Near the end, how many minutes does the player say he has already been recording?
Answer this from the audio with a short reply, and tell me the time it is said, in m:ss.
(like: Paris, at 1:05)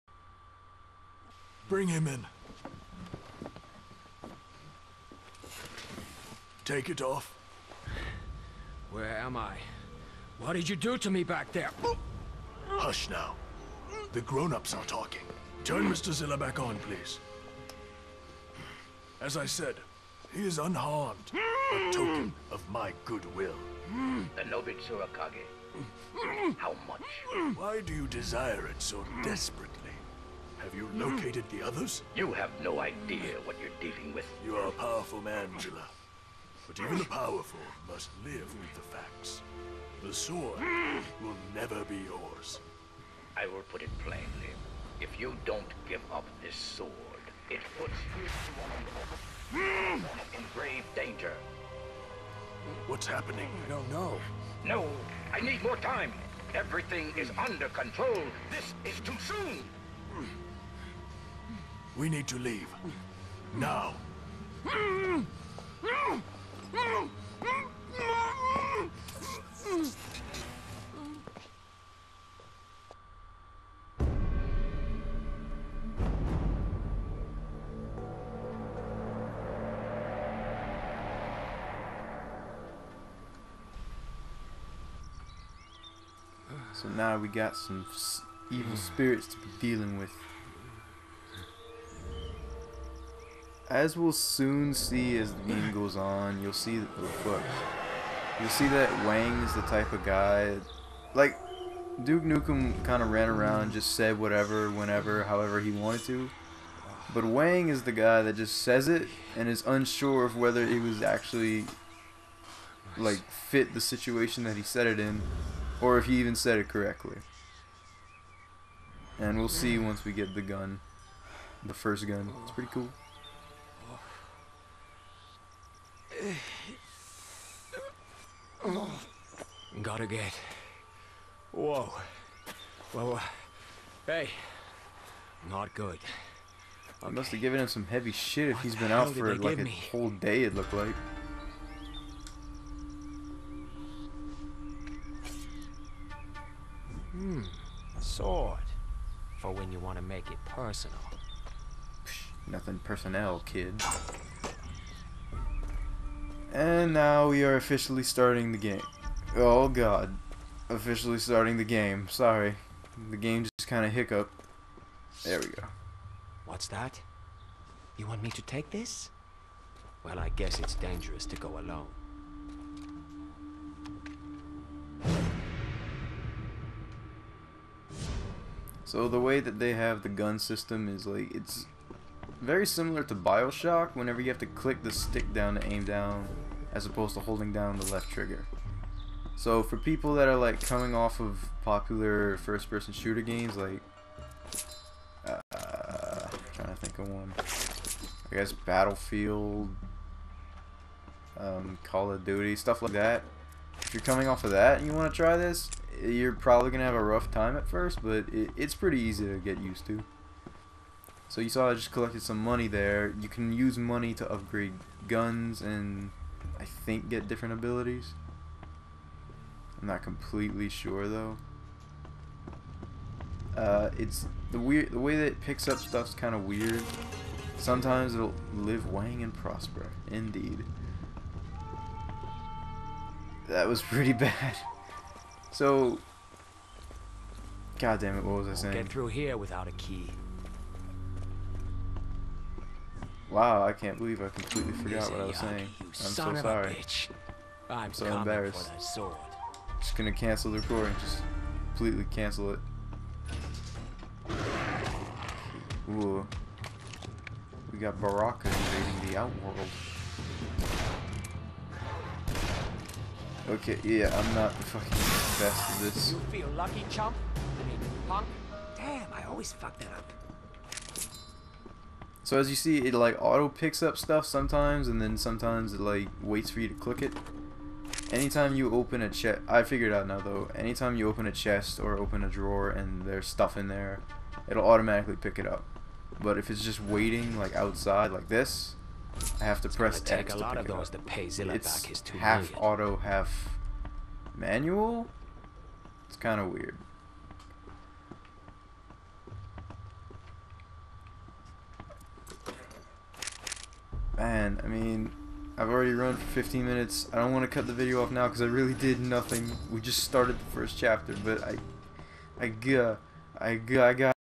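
15, at 5:06.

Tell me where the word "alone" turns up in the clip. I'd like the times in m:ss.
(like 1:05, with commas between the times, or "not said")
2:51.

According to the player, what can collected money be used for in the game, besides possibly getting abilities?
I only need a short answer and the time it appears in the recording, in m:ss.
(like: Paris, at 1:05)
upgrade guns, at 3:34.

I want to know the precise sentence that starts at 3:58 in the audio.
Get through here without a key.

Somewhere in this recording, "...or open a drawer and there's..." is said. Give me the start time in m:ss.
4:41.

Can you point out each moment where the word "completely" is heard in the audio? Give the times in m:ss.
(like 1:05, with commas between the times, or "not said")
3:40, 4:04, 4:11.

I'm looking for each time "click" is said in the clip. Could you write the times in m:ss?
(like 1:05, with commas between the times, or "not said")
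3:04, 4:36.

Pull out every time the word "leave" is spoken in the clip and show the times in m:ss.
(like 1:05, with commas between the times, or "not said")
1:02.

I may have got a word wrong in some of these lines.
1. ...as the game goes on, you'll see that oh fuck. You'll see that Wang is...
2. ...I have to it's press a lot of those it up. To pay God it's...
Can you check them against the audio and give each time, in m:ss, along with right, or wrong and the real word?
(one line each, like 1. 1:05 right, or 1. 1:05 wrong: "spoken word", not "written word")
1. 1:35 right
2. 4:49 wrong: "Zilla", not "God".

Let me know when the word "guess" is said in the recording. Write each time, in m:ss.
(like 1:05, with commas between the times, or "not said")
2:50, 3:18.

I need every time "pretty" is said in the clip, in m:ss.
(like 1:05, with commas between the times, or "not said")
2:02, 3:28, 3:53.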